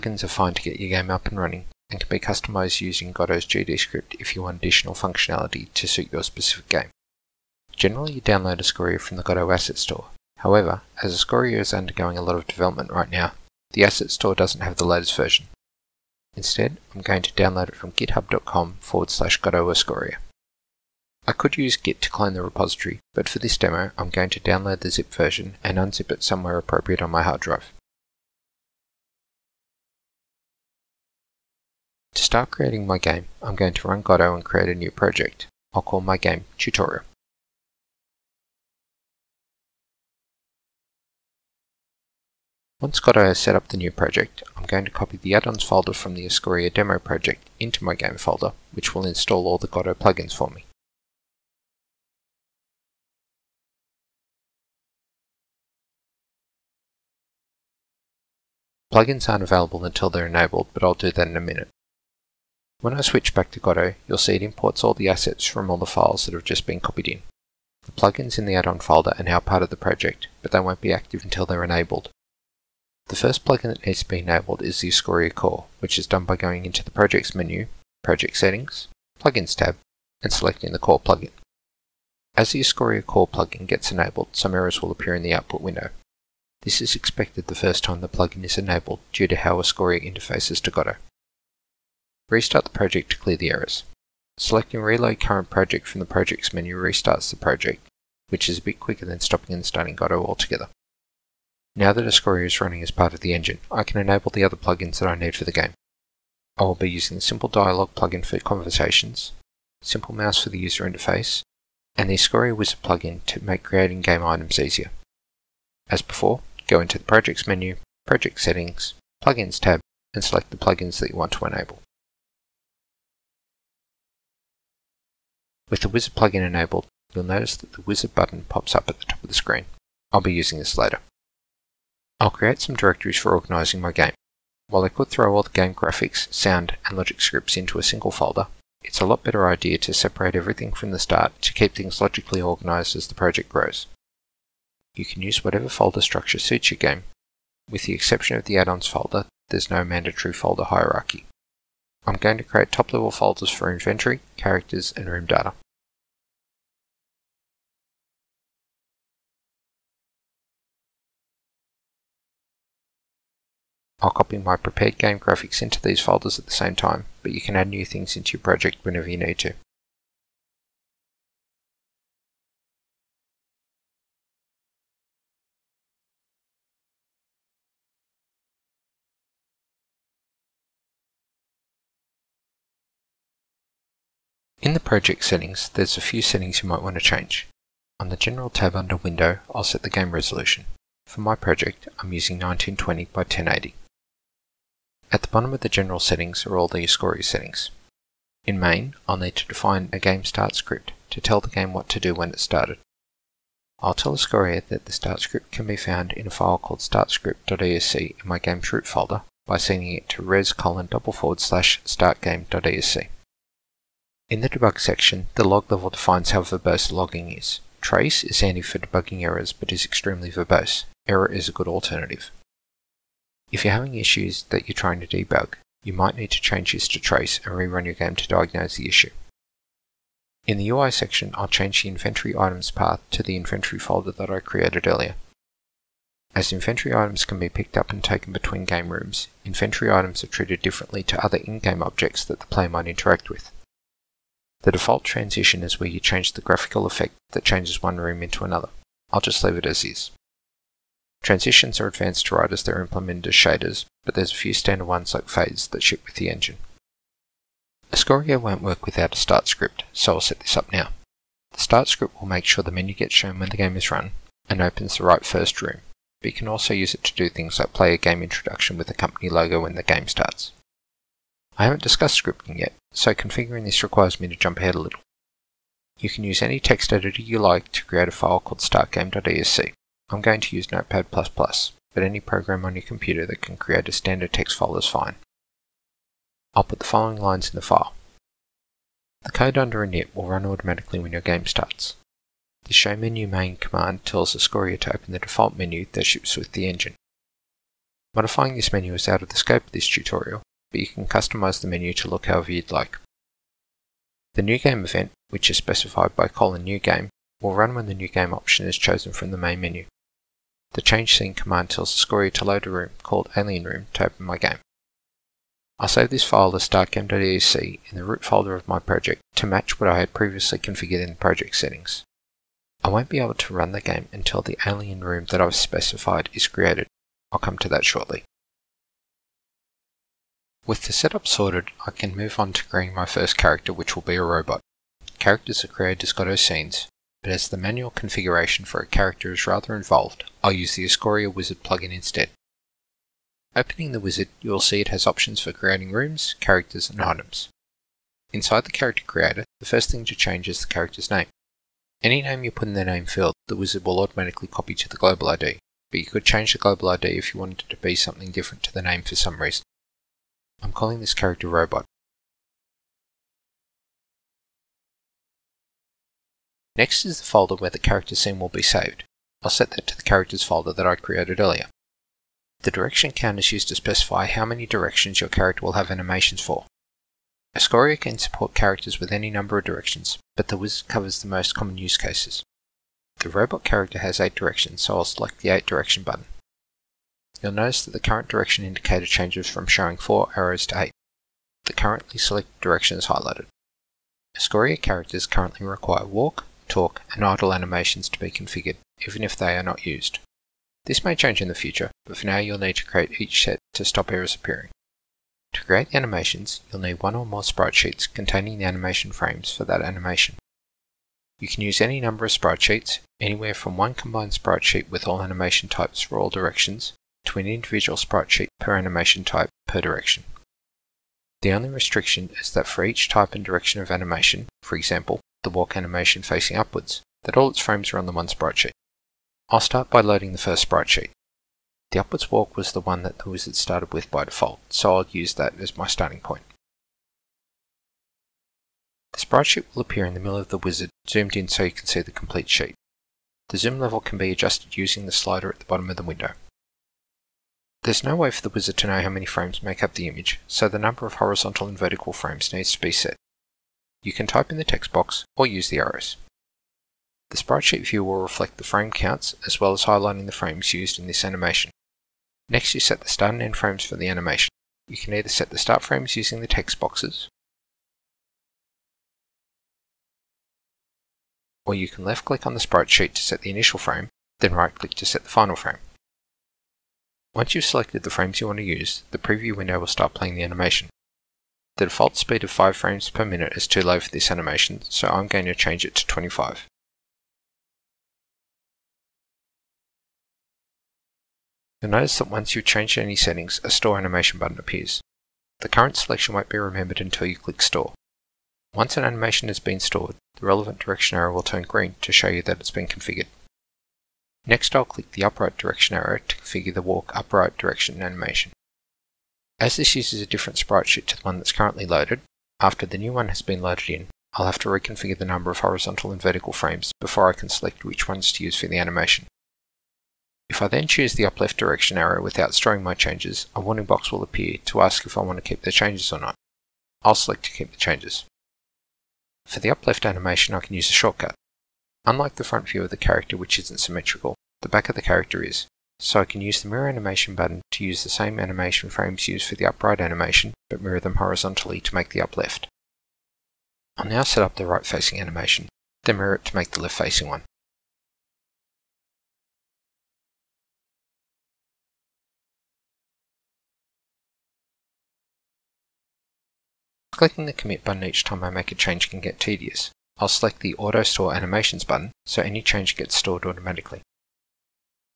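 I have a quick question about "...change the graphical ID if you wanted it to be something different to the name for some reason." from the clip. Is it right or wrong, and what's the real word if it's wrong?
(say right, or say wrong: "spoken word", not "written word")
wrong: "global", not "graphical".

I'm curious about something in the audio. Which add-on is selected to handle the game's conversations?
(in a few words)
Simple Dialog.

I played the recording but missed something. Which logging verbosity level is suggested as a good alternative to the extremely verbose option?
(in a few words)
Error.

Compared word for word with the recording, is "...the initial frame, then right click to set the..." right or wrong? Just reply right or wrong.
right.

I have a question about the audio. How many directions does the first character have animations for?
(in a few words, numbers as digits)
8.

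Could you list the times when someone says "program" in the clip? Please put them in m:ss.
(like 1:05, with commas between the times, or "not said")
4:42.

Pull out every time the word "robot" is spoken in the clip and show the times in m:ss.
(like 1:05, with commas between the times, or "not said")
5:34, 6:01, 6:23.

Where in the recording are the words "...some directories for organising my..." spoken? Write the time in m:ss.
2:12.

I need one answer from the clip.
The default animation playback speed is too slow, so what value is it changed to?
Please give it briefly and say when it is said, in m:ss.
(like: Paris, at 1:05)
25, at 8:06.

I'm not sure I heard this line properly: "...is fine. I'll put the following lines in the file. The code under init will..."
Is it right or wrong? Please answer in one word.
right.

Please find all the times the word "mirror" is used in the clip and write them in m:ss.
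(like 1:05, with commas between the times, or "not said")
8:56, 9:00, 9:06.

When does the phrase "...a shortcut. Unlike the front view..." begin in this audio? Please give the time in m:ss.
8:50.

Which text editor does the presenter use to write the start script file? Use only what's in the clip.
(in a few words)
Notepad++.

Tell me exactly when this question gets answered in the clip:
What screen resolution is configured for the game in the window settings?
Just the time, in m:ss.
3:12.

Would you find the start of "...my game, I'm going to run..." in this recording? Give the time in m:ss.
0:32.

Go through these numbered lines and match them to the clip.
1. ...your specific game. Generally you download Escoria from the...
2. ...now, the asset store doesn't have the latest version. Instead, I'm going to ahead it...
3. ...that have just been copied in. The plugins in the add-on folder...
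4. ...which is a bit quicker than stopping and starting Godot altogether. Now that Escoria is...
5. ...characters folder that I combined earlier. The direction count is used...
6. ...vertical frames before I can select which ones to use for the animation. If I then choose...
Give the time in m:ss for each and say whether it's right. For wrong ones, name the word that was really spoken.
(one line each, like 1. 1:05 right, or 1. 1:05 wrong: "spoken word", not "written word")
1. 0:06 right
2. 0:13 wrong: "download", not "ahead"
3. 1:06 right
4. 1:38 right
5. 6:10 wrong: "created", not "combined"
6. 8:36 right.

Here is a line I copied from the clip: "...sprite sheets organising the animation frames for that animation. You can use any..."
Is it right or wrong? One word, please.
wrong.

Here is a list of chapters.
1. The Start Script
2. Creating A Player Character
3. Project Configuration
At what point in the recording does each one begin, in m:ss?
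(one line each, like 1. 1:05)
1. 4:17
2. 5:29
3. 3:01.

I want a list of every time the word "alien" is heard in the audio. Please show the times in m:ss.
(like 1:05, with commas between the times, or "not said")
5:13, 5:24.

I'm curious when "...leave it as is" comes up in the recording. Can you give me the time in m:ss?
4:09.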